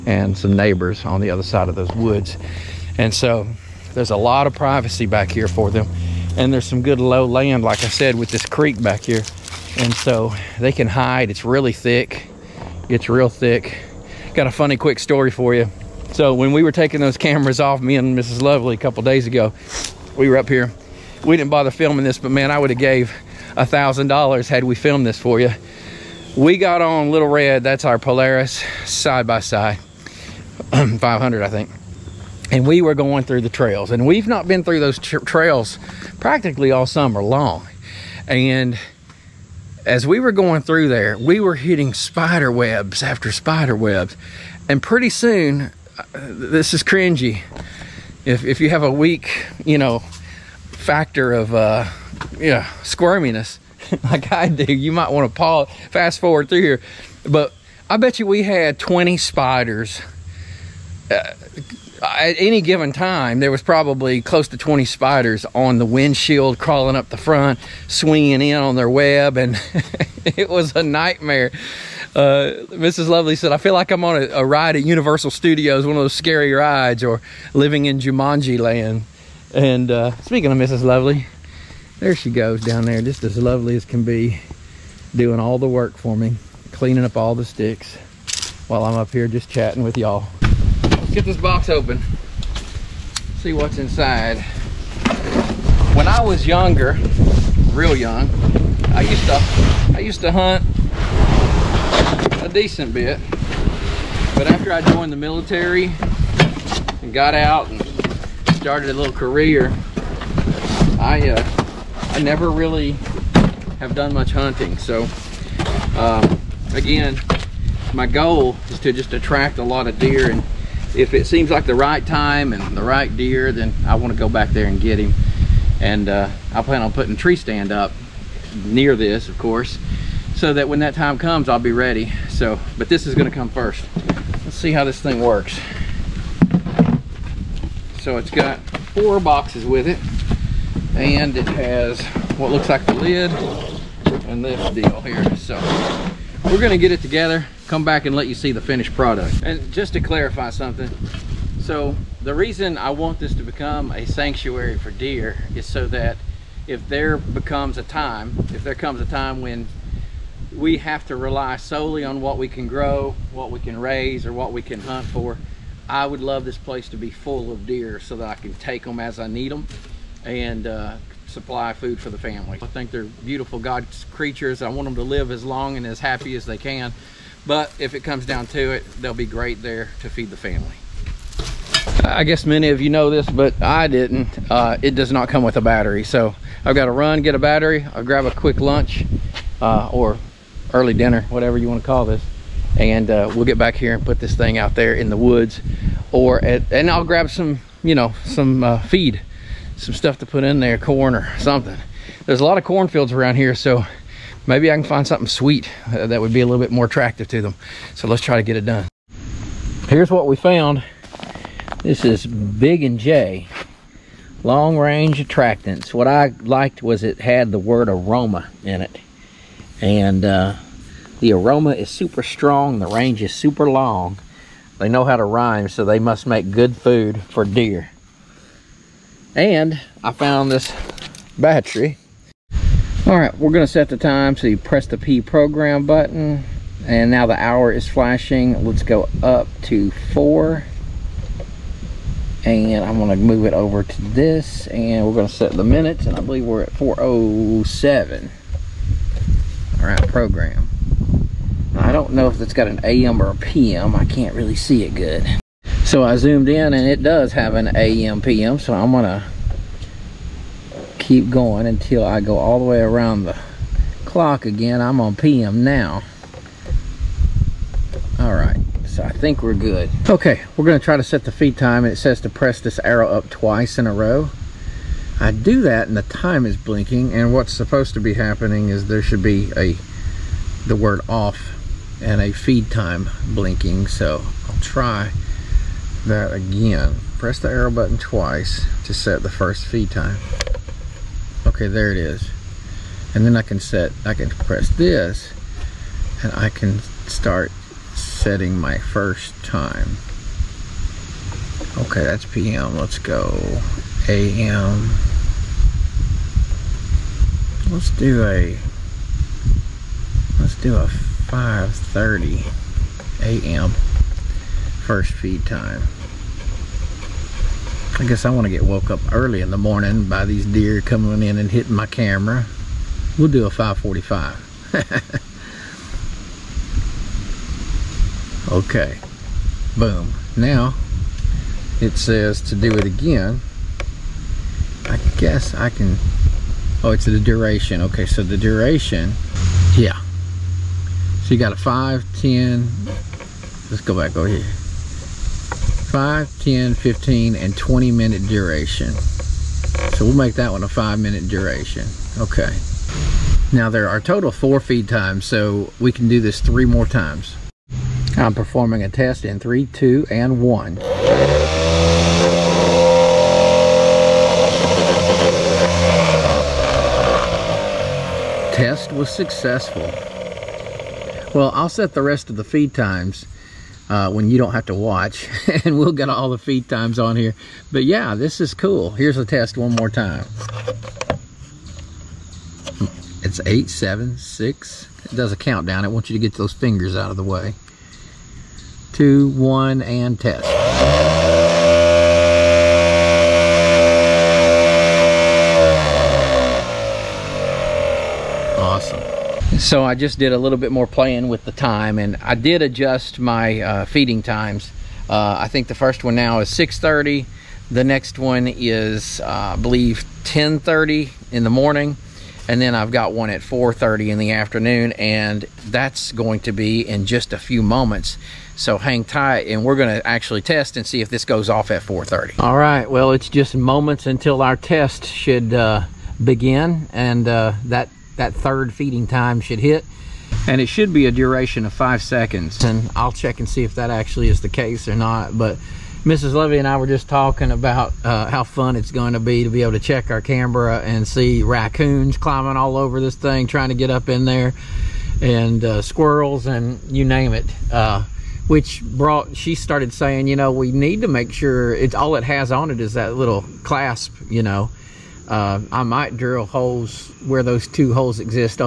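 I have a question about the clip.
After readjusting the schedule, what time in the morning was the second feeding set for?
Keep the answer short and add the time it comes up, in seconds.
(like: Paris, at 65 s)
10:30, at 410 s.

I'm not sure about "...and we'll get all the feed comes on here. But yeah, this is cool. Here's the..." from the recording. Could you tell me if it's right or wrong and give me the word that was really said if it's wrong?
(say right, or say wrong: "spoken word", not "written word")
wrong: "times", not "comes".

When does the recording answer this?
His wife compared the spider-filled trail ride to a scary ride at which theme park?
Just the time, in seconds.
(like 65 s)
74 s.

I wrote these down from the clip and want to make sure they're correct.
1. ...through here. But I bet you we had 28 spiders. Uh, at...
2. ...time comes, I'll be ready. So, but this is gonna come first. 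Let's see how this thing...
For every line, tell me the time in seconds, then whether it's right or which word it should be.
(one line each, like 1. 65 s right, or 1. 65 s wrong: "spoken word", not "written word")
1. 56 s wrong: "20", not "28"
2. 130 s right.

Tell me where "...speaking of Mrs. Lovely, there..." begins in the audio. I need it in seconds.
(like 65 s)
80 s.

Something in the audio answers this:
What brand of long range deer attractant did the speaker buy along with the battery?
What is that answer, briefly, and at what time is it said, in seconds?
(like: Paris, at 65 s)
Big and J, at 212 s.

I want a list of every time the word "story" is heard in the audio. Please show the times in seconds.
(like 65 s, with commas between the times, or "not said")
14 s.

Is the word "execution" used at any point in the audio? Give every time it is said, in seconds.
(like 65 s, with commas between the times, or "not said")
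not said.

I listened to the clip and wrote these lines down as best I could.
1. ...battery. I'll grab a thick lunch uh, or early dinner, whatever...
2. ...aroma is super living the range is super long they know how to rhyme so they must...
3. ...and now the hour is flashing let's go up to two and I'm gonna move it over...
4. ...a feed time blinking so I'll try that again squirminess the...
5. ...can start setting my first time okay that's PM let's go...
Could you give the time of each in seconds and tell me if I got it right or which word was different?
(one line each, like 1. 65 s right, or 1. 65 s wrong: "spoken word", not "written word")
1. 187 s wrong: "quick", not "thick"
2. 221 s wrong: "strong", not "living"
3. 236 s wrong: "four", not "two"
4. 282 s wrong: "press", not "squirminess"
5. 296 s right.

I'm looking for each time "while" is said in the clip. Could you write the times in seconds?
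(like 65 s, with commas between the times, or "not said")
88 s.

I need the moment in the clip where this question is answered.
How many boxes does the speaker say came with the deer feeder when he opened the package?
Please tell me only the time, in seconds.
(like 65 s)
138 s.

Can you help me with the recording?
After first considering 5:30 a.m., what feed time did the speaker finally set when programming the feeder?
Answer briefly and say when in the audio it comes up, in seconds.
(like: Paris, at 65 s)
5:45, at 323 s.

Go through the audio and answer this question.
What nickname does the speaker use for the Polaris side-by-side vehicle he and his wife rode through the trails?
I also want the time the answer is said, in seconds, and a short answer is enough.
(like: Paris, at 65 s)
Little Red, at 27 s.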